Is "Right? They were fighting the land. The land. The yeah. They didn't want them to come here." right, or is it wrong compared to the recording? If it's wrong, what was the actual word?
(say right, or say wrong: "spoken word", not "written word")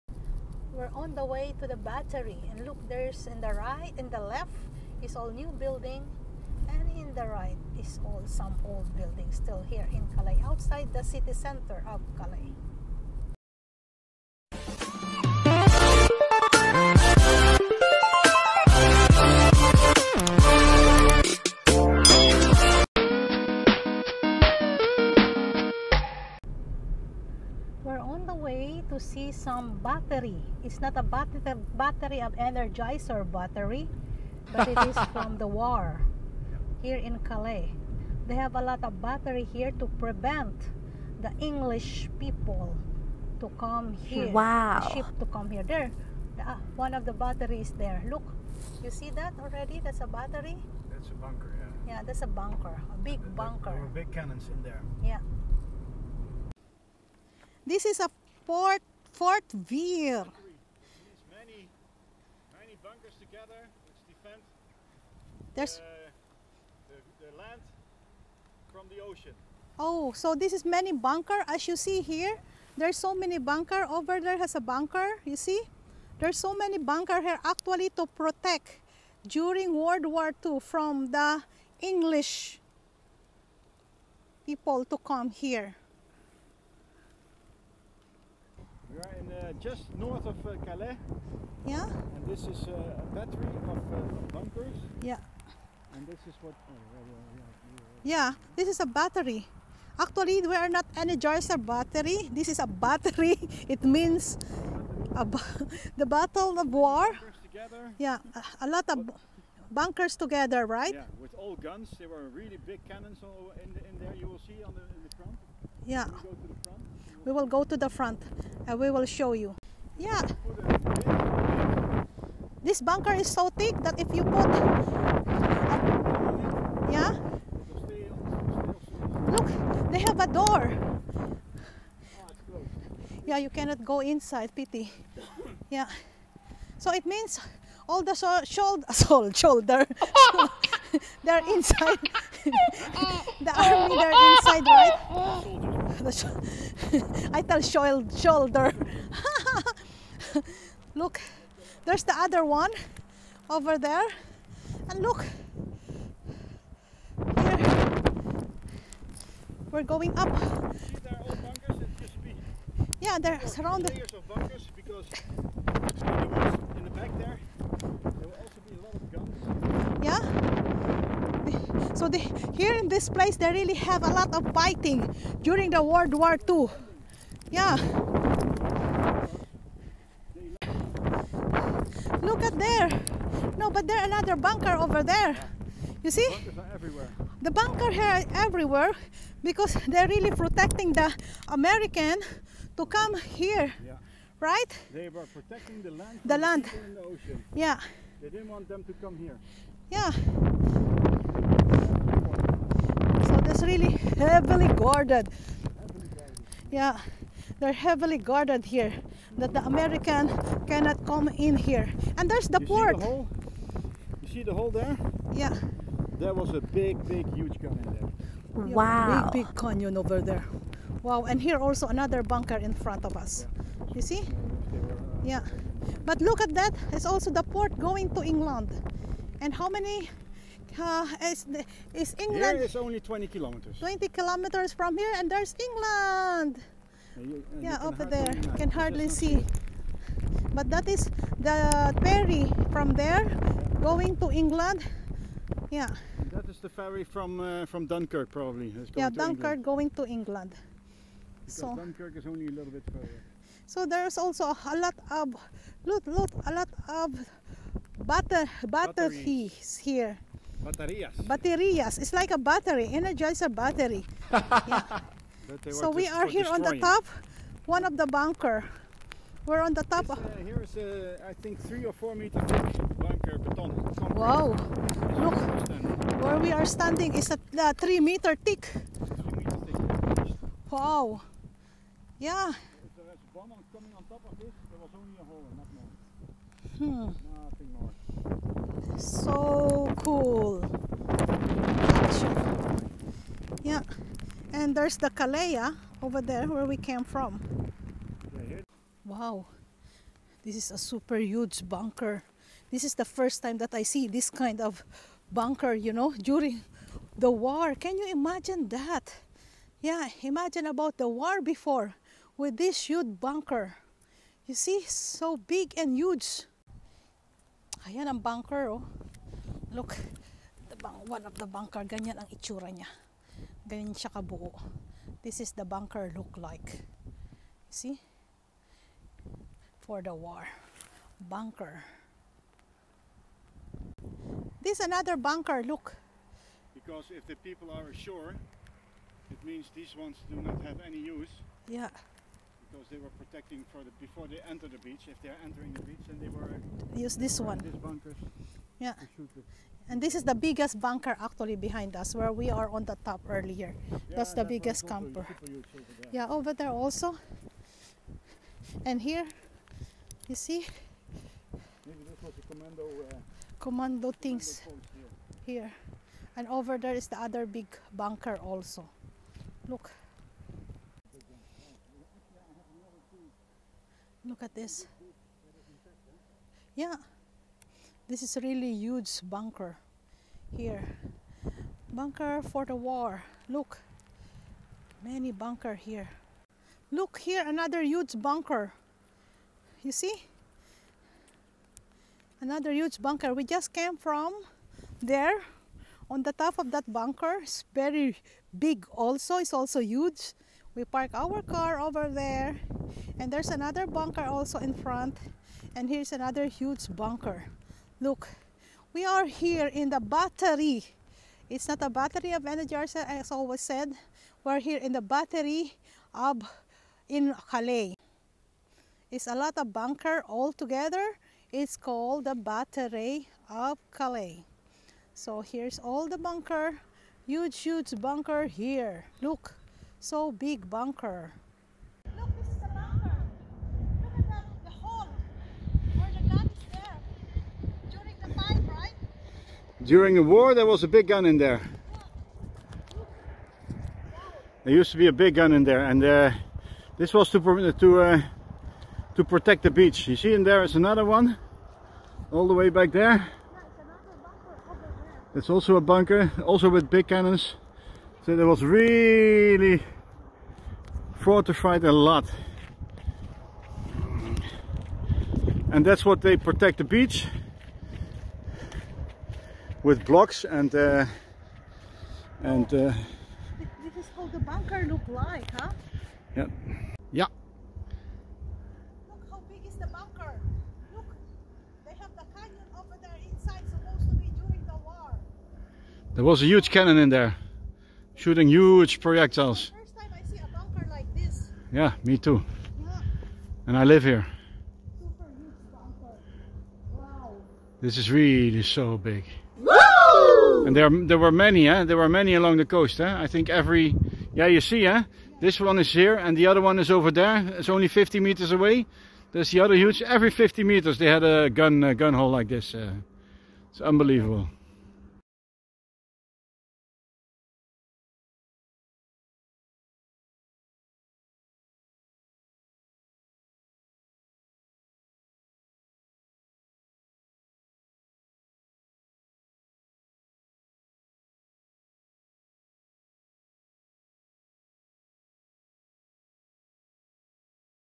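wrong: "protecting", not "fighting".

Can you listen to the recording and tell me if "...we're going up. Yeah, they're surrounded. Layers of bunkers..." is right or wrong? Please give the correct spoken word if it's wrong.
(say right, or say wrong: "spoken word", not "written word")
right.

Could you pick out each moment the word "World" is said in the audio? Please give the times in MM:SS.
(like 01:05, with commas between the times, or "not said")
01:19, 02:55.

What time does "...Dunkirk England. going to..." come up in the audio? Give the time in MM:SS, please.
04:09.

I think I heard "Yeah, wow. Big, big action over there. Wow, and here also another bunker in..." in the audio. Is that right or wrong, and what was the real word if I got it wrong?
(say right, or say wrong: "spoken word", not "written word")
wrong: "canyon", not "action".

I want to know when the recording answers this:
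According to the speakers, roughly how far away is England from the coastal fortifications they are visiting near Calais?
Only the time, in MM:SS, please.
03:53.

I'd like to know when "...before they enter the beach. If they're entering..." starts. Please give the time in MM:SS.
05:43.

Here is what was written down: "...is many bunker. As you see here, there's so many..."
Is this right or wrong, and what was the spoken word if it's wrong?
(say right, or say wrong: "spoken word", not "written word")
right.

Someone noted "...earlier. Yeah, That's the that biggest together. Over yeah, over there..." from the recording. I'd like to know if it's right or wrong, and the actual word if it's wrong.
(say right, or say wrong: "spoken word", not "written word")
wrong: "camper", not "together".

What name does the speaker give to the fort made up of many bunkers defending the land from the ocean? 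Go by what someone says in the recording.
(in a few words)
Fort Veer.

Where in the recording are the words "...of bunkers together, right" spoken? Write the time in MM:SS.
01:48.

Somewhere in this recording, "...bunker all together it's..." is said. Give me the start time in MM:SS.
06:59.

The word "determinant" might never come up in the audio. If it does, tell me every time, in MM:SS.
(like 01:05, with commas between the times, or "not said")
not said.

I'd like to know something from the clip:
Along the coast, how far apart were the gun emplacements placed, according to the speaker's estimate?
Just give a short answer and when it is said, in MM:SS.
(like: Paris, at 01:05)
50 meters, at 08:30.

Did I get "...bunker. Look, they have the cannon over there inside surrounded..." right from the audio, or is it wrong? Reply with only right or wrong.
wrong.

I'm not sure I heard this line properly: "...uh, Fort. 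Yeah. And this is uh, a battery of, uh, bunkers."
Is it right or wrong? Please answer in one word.
wrong.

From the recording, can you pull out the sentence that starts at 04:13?
So there's also a lot of look, look, a lot of butter, butter here.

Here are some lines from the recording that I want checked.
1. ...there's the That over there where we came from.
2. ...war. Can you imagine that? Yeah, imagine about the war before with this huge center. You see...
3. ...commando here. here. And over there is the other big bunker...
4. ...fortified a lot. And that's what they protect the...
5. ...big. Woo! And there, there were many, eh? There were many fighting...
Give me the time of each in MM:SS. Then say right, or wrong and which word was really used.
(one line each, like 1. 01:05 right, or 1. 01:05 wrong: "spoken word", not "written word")
1. 04:54 wrong: "Calais", not "That"
2. 05:07 wrong: "bunker", not "center"
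3. 06:04 right
4. 07:41 right
5. 08:18 wrong: "along", not "fighting".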